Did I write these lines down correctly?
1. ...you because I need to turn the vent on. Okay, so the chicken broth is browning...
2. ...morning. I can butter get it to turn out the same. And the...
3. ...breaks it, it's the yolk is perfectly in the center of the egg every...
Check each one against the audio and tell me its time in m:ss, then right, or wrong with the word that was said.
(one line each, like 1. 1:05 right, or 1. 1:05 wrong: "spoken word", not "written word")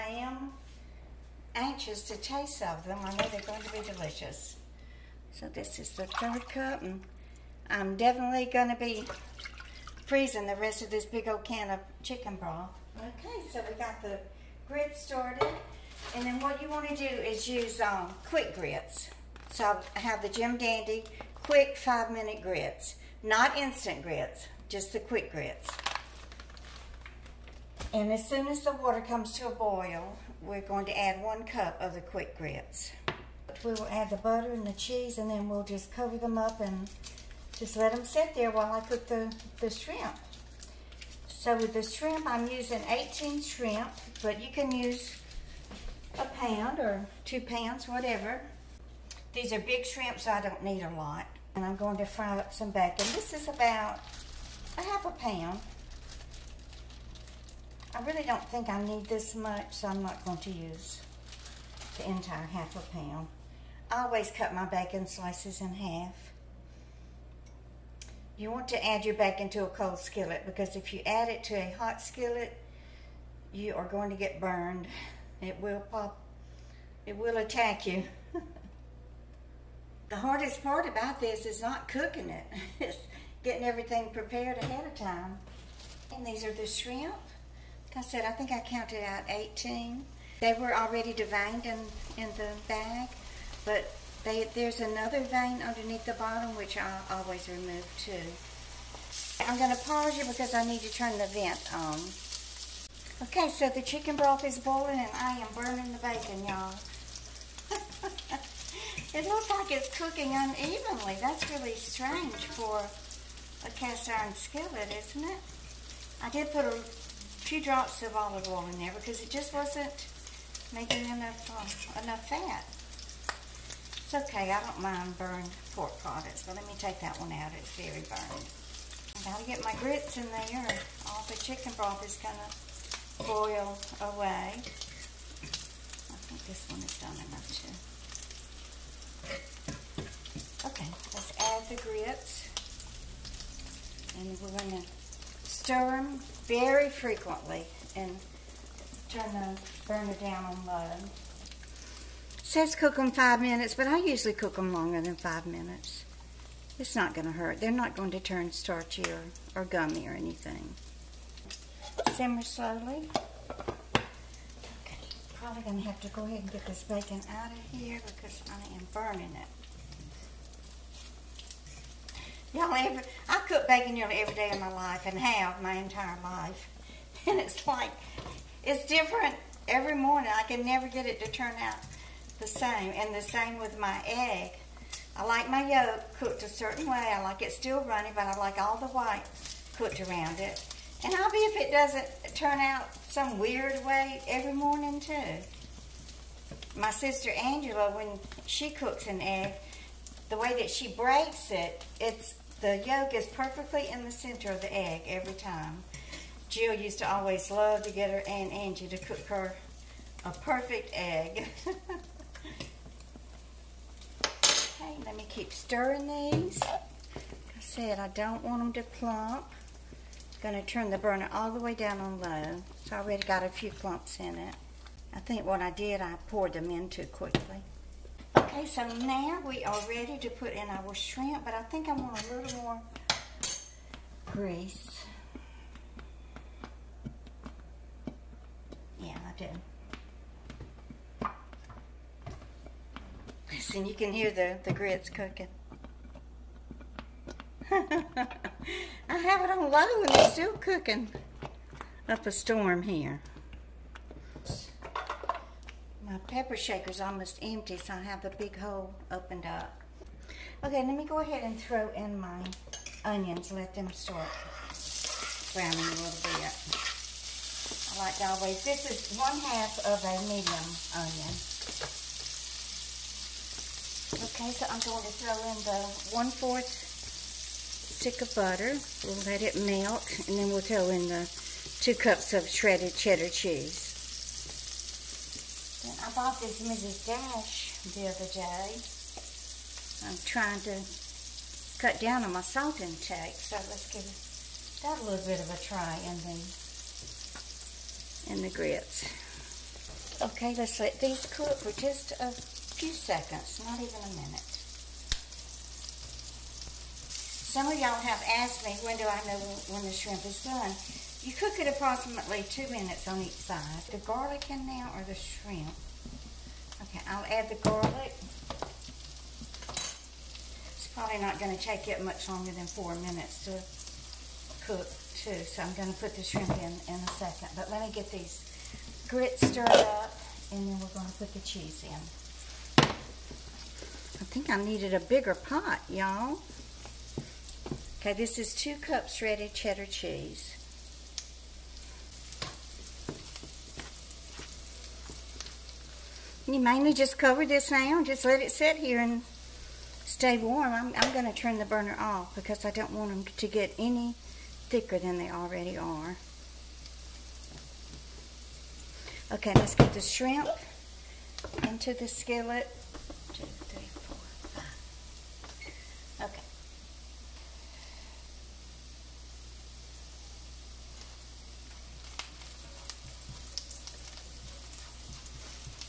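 1. 1:40 wrong: "boiling", not "browning"
2. 2:59 wrong: "never", not "butter"
3. 3:20 right.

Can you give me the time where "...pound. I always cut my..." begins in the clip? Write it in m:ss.
1:02.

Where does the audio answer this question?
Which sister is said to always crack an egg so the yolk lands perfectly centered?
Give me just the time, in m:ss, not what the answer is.
3:17.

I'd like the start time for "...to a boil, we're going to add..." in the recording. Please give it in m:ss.
0:29.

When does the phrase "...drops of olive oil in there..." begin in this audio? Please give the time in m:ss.
1:57.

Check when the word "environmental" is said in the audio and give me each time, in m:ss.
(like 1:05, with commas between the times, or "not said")
not said.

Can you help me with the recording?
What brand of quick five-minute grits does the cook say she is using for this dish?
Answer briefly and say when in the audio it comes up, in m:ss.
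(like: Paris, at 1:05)
Jim Dandy, at 0:20.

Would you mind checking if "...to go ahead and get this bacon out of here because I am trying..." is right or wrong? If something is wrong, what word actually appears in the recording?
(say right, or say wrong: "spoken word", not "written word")
wrong: "burning", not "trying".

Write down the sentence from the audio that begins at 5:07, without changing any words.
Some of y'all have asked me, when do I know when the shrimp is done?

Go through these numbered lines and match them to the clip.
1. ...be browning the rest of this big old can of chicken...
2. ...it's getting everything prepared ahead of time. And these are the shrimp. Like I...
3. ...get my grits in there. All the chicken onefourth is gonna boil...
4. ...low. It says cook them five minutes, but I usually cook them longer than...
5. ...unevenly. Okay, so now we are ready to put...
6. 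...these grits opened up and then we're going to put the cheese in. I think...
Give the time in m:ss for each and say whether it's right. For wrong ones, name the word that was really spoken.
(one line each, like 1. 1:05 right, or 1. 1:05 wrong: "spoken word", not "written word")
1. 0:08 wrong: "freezing", not "browning"
2. 1:22 right
3. 2:09 wrong: "broth", not "onefourth"
4. 2:30 right
5. 3:47 wrong: "quickly", not "unevenly"
6. 5:28 wrong: "stirred", not "opened".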